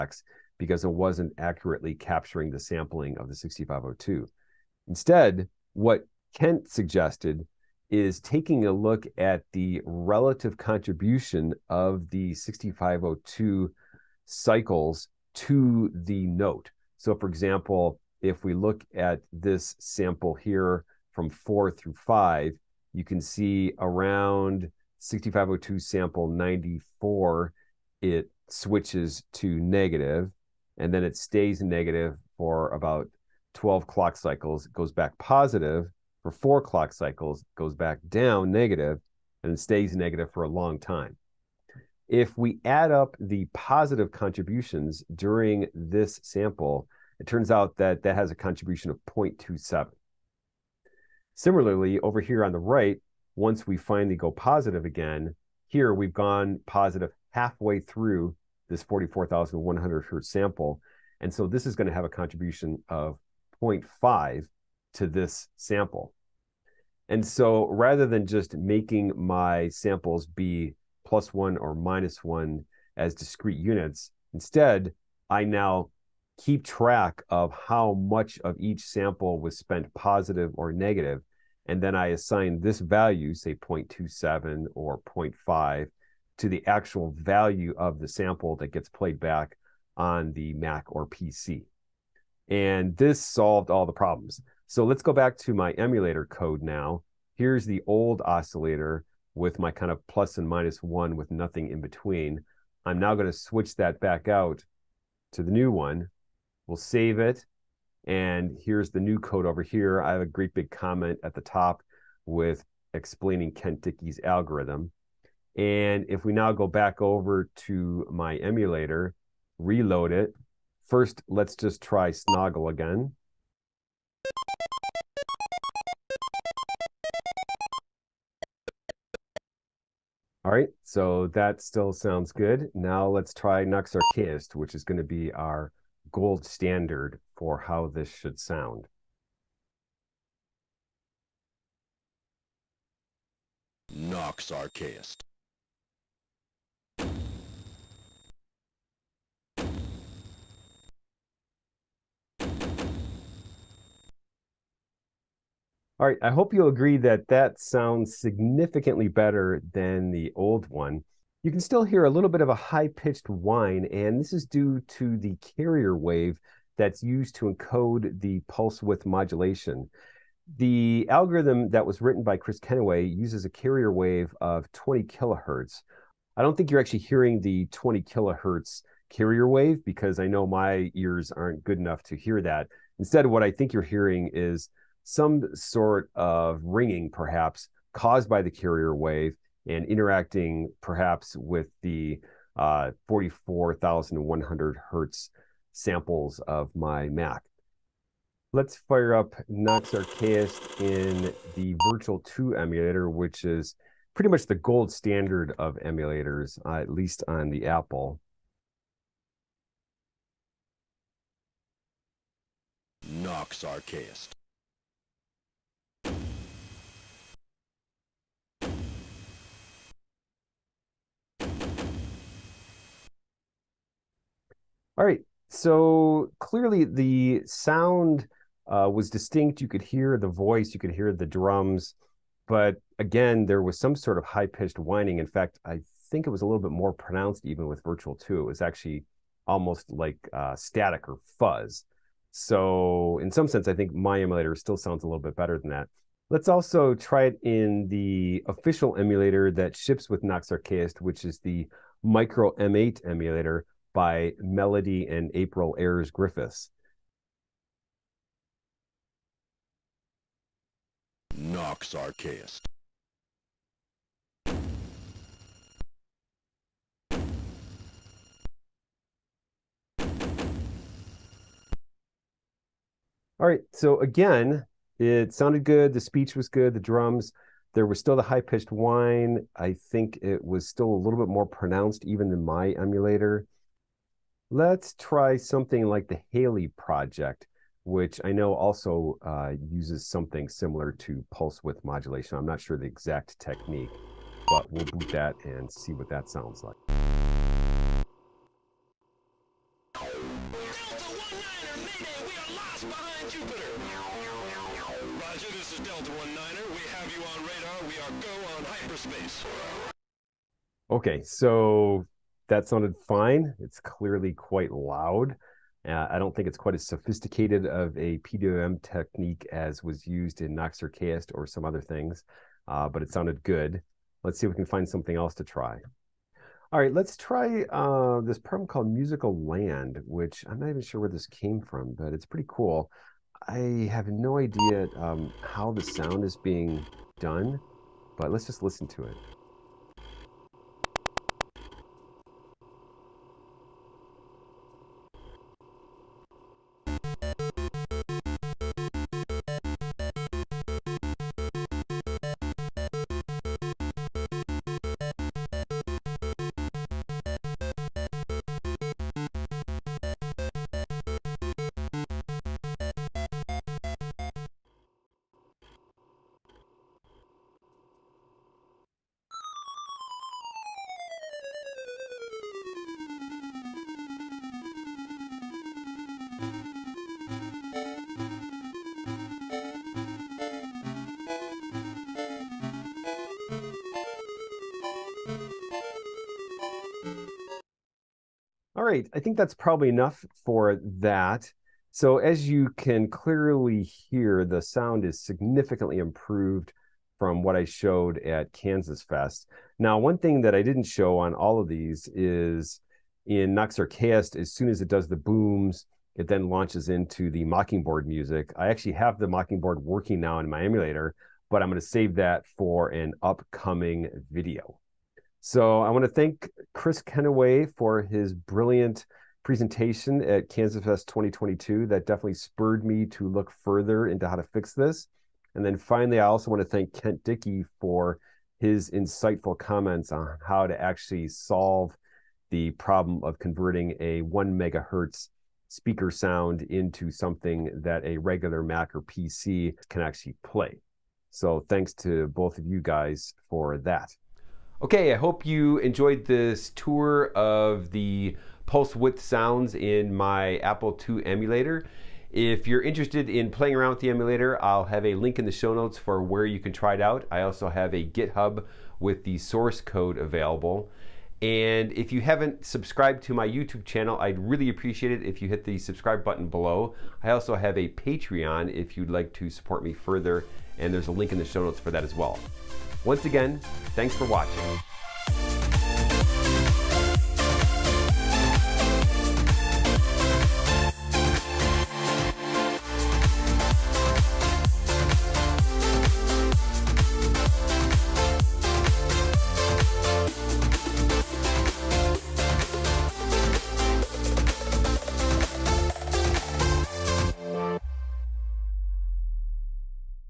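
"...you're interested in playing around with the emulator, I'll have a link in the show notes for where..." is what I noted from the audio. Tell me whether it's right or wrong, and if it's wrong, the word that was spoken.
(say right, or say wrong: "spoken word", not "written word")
right.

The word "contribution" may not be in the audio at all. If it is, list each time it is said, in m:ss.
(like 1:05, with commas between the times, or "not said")
0:10, 0:44, 0:48, 1:02.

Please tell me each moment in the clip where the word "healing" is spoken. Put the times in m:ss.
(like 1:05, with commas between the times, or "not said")
not said.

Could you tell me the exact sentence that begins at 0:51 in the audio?
Similarly, over here on the right, once we finally go positive again, here we've gone positive halfway through this 44,100 hertz sample.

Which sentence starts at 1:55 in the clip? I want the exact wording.
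And if we now go back over to my emulator, reload it.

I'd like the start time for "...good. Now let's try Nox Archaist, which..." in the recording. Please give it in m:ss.
2:12.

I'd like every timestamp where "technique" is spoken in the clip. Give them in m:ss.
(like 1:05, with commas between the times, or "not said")
4:53, 5:18.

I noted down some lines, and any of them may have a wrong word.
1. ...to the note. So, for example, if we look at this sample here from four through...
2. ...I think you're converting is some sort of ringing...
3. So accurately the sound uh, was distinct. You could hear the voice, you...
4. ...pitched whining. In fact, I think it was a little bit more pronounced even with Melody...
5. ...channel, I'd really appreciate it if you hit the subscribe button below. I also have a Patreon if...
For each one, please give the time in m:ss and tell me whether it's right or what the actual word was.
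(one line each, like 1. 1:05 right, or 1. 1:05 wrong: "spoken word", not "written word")
1. 0:15 right
2. 3:03 wrong: "hearing", not "converting"
3. 3:45 wrong: "clearly", not "accurately"
4. 3:54 wrong: "Virtual", not "Melody"
5. 7:43 right.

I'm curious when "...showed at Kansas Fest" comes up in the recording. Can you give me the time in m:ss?
6:37.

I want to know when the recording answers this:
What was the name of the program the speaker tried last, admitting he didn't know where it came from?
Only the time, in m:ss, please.
5:28.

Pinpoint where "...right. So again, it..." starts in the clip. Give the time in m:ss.
4:33.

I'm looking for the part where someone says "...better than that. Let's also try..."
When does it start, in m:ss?
4:05.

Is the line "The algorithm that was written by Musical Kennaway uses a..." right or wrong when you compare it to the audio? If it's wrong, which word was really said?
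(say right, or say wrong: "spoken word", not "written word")
wrong: "Kris", not "Musical".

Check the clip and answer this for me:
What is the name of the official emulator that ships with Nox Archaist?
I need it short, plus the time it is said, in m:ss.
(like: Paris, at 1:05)
Micro M8, at 4:12.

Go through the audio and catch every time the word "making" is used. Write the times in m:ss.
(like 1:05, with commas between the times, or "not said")
1:08.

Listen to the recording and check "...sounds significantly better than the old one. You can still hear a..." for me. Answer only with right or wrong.
right.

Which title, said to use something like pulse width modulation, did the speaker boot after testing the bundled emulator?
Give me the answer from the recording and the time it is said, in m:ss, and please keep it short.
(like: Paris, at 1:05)
Halley Project, at 4:46.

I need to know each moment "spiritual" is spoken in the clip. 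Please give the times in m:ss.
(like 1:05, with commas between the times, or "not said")
not said.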